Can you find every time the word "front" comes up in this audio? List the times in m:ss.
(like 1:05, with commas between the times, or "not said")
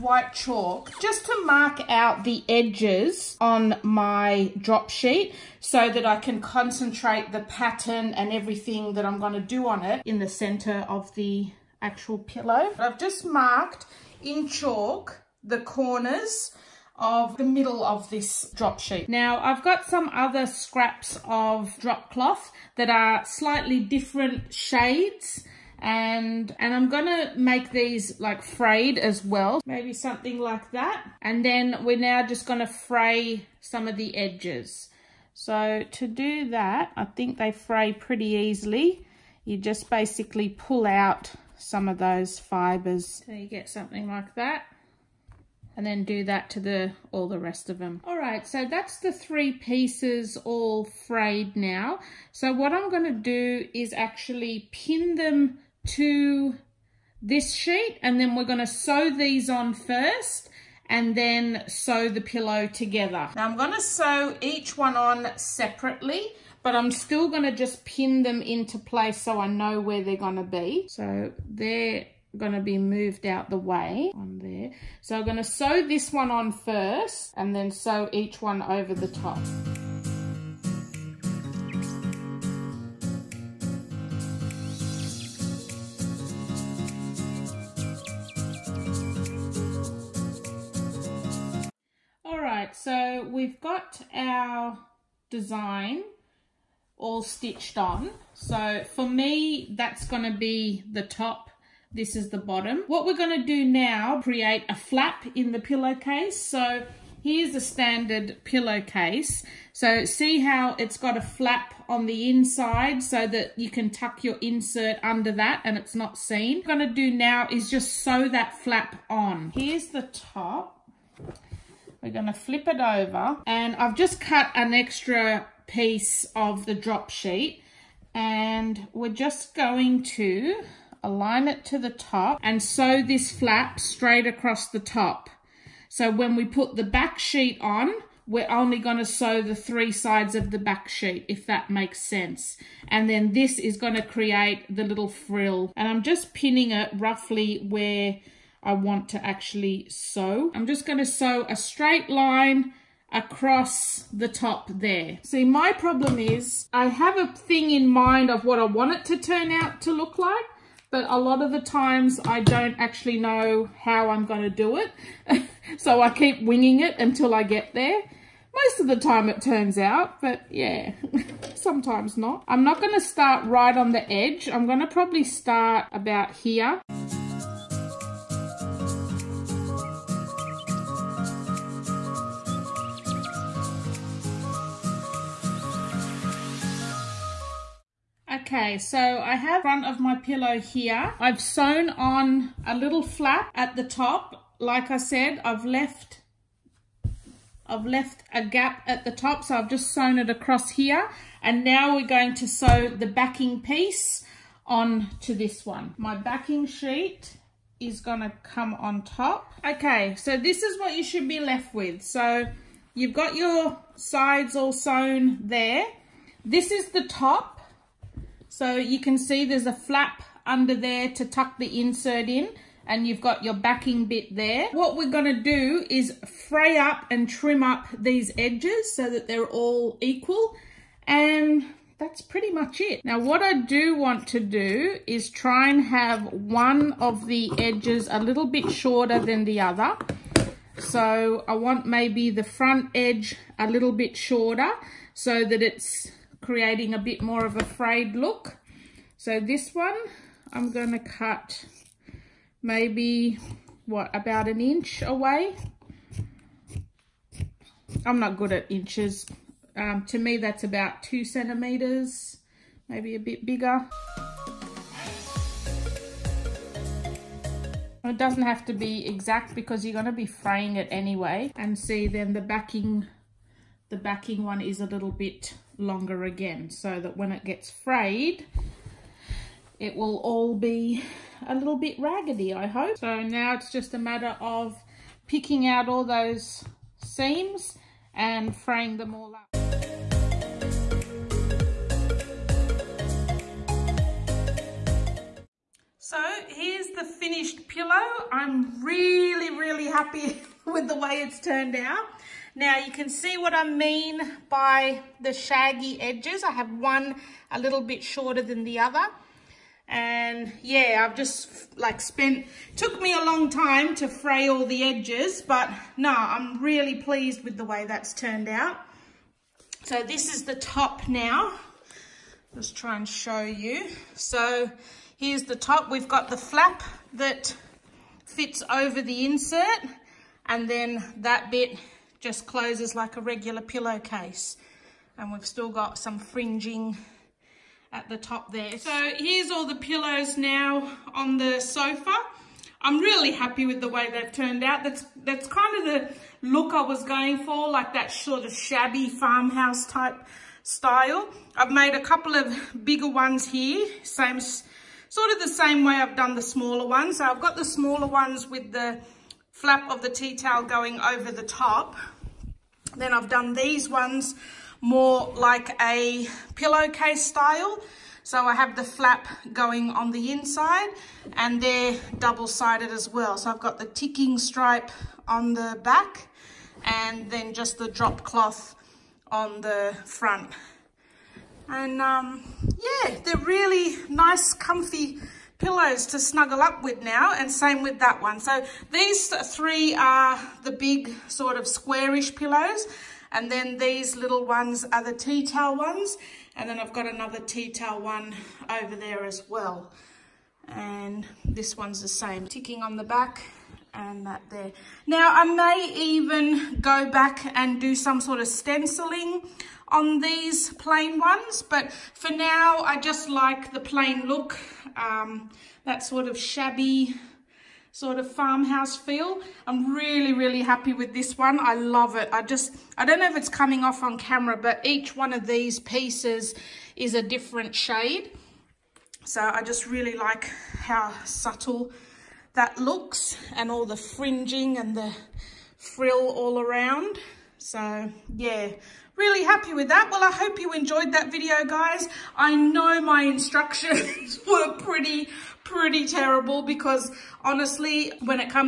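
3:09, 4:02, 6:20.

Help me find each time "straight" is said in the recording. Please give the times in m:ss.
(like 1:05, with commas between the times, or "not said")
2:13, 2:31.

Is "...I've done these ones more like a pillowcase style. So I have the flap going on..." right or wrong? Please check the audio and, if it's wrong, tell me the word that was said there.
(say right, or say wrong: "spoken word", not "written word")
right.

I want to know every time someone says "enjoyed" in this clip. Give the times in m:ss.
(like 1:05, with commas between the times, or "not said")
7:20.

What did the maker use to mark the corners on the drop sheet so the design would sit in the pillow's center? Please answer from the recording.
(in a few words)
white chalk.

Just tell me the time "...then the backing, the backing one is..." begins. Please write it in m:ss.
4:32.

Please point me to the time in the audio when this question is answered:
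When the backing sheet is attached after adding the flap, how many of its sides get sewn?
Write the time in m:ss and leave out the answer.
2:19.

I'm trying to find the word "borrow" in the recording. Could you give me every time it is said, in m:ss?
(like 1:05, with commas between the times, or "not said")
not said.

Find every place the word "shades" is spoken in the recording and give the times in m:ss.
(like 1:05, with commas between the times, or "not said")
0:24, 7:07.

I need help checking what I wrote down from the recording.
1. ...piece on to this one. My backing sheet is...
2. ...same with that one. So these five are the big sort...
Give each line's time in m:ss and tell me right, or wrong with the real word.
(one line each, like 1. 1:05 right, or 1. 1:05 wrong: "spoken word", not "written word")
1. 3:23 right
2. 6:27 wrong: "three", not "five".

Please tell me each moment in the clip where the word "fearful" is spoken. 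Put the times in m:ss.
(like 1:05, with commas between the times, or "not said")
not said.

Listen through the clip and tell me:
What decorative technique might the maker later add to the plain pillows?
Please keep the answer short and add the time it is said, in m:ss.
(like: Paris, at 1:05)
stenciling, at 6:48.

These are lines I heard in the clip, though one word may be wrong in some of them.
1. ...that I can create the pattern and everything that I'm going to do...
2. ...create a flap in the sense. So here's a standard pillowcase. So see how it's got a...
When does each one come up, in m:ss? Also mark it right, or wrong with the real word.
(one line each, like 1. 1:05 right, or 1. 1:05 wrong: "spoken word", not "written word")
1. 0:05 wrong: "concentrate", not "create"
2. 1:44 wrong: "pillowcase", not "sense".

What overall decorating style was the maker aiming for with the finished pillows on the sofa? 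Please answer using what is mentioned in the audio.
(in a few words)
shabby farmhouse.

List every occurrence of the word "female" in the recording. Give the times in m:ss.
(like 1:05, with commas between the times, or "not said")
not said.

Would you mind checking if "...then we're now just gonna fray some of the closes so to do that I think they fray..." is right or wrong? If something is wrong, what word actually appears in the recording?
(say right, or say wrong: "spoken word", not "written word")
wrong: "edges", not "closes".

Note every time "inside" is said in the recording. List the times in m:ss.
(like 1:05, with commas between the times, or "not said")
1:52, 6:10.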